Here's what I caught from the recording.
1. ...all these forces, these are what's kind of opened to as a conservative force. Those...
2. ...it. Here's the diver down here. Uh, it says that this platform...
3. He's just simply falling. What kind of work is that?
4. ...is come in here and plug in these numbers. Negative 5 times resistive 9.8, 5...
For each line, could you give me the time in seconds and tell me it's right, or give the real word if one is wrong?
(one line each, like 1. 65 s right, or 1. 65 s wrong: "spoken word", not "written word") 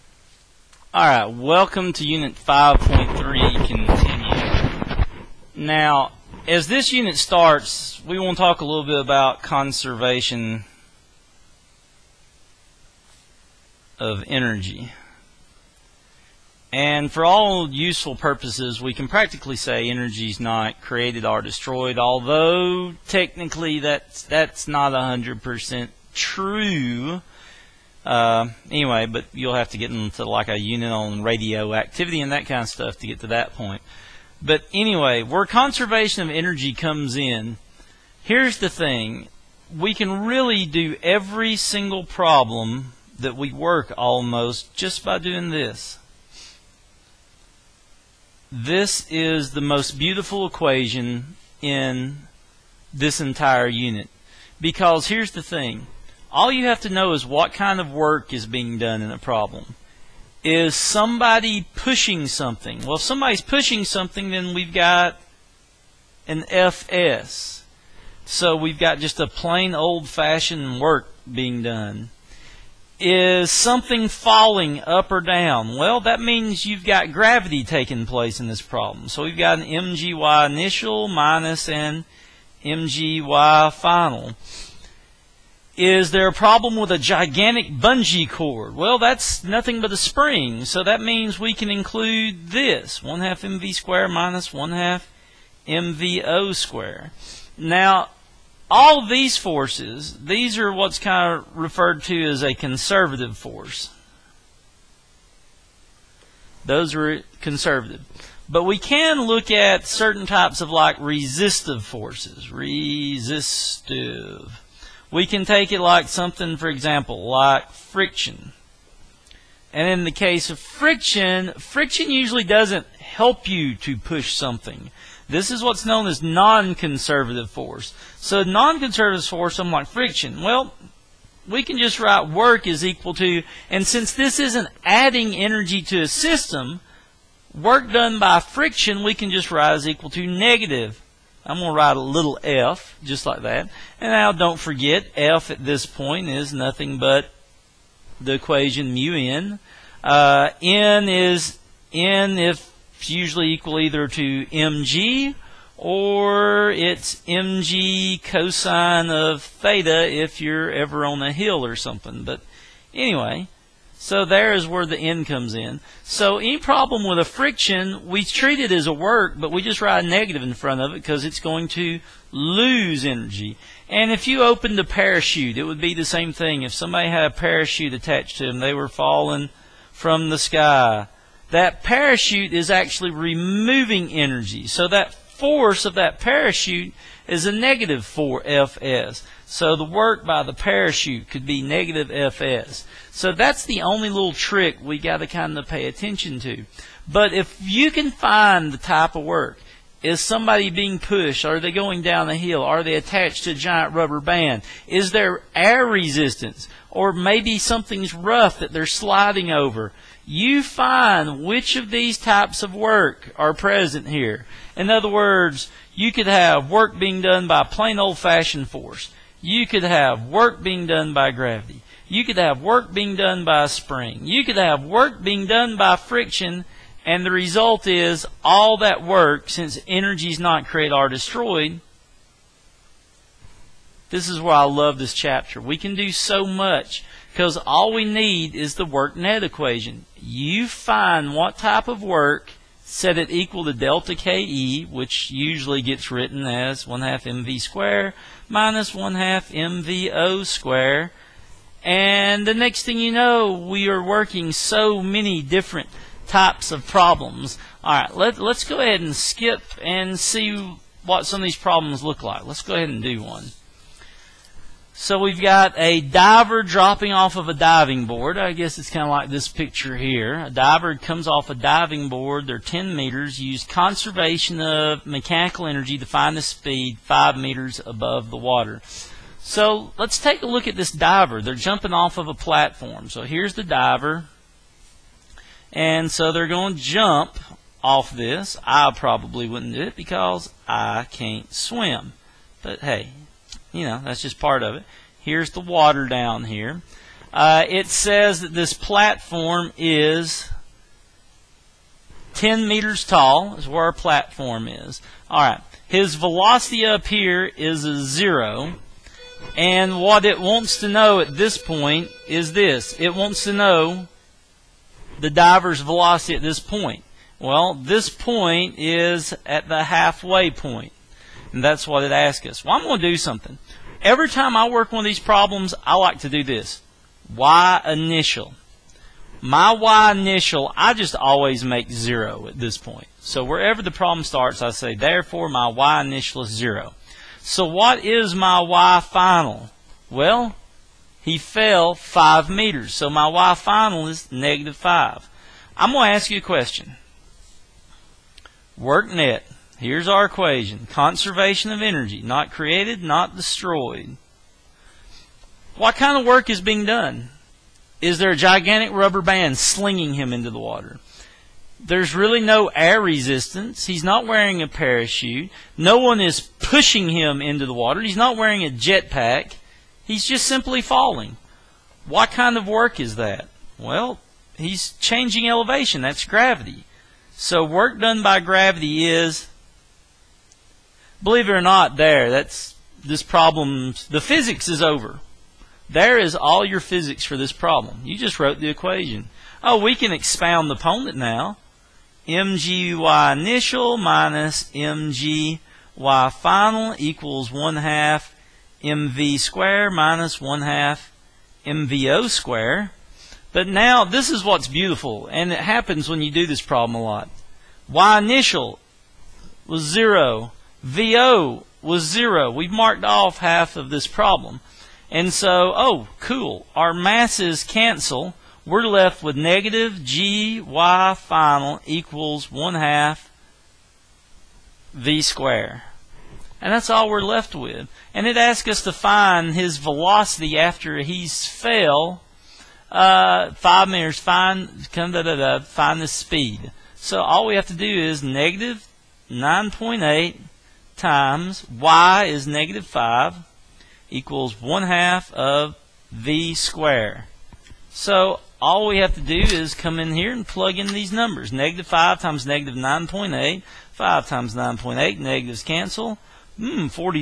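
1. 98 s wrong: "referred", not "opened"
2. 294 s wrong: "water", not "diver"
3. 370 s right
4. 449 s wrong: "negative", not "resistive".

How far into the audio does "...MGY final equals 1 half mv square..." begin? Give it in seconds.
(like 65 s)
394 s.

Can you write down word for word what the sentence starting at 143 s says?
And now don't forget, f at this point is nothing but the equation mu n.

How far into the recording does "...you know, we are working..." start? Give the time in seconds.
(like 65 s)
252 s.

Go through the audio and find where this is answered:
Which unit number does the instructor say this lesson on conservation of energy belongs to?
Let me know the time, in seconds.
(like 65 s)
2 s.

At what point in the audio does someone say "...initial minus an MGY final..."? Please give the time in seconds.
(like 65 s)
80 s.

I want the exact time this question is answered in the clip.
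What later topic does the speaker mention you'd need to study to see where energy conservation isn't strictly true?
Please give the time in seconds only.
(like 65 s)
31 s.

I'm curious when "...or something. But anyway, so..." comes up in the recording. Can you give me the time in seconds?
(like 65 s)
161 s.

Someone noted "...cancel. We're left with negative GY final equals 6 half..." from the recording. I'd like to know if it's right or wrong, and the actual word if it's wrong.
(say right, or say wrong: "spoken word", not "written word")
wrong: "1", not "6".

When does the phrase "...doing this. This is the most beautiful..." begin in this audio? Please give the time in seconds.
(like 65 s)
45 s.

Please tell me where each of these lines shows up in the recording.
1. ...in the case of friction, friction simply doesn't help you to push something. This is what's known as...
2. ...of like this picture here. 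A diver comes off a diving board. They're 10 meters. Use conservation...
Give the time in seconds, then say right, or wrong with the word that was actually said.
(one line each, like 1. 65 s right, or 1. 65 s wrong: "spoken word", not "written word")
1. 119 s wrong: "usually", not "simply"
2. 269 s right.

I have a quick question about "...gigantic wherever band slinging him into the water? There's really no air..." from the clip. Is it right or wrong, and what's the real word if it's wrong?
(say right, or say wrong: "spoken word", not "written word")
wrong: "rubber", not "wherever".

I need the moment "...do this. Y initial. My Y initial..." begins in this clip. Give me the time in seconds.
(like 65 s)
326 s.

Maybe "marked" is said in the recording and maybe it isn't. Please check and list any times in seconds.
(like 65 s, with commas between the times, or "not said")
412 s.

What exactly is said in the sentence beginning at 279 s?
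So let's take a look at this diver.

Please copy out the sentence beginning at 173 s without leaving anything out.
And if you opened a parachute, it would be the same thing.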